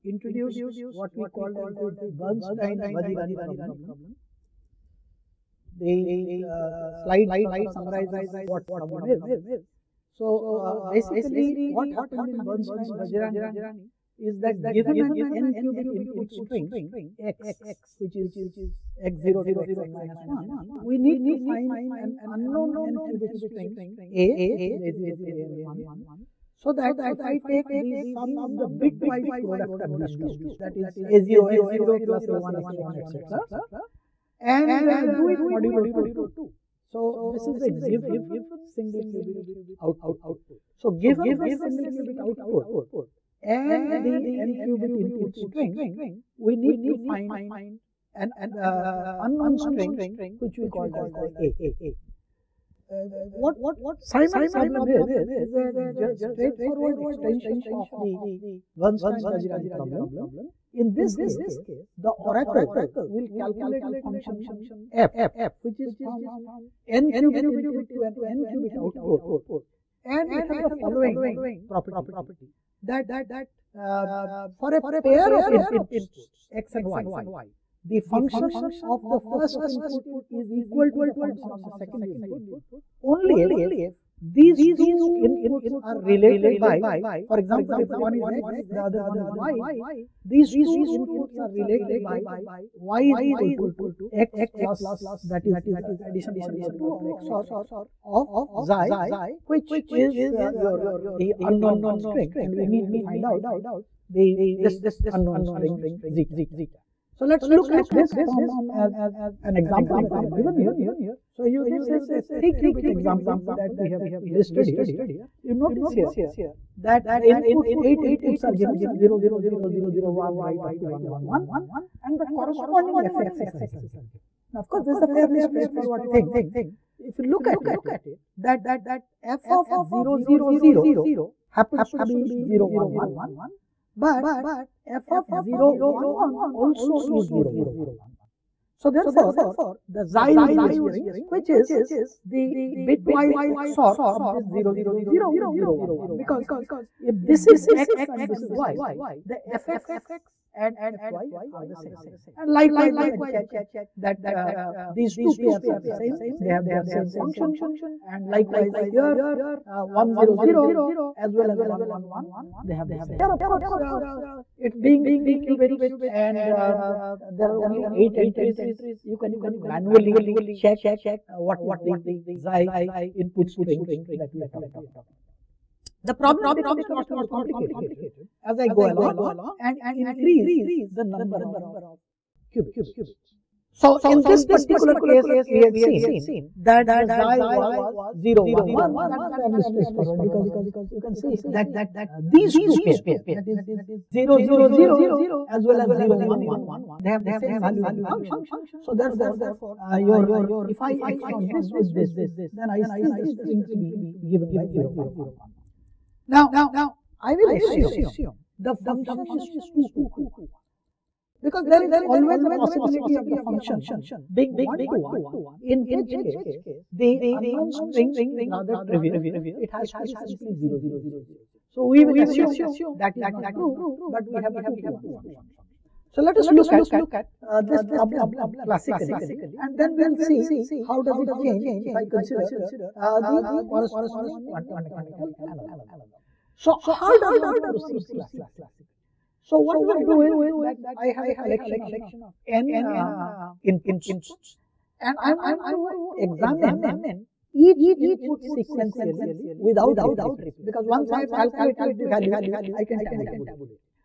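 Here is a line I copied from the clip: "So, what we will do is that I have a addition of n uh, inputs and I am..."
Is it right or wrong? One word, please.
wrong.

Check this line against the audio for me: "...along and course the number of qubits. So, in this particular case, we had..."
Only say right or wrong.
wrong.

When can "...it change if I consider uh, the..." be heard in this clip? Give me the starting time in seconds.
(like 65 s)
231 s.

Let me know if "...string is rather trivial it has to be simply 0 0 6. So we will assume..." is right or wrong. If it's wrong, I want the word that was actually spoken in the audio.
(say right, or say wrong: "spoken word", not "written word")
wrong: "0", not "6".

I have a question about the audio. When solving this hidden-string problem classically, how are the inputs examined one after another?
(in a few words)
sequentially without replacement.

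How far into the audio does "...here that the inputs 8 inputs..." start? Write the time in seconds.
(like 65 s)
115 s.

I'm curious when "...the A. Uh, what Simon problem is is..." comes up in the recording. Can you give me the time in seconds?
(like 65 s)
51 s.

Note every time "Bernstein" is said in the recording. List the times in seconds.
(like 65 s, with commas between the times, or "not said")
2 s, 12 s, 58 s.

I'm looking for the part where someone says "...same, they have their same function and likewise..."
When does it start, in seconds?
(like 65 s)
155 s.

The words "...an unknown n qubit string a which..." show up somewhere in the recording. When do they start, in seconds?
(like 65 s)
21 s.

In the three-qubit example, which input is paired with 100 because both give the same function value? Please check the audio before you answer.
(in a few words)
111.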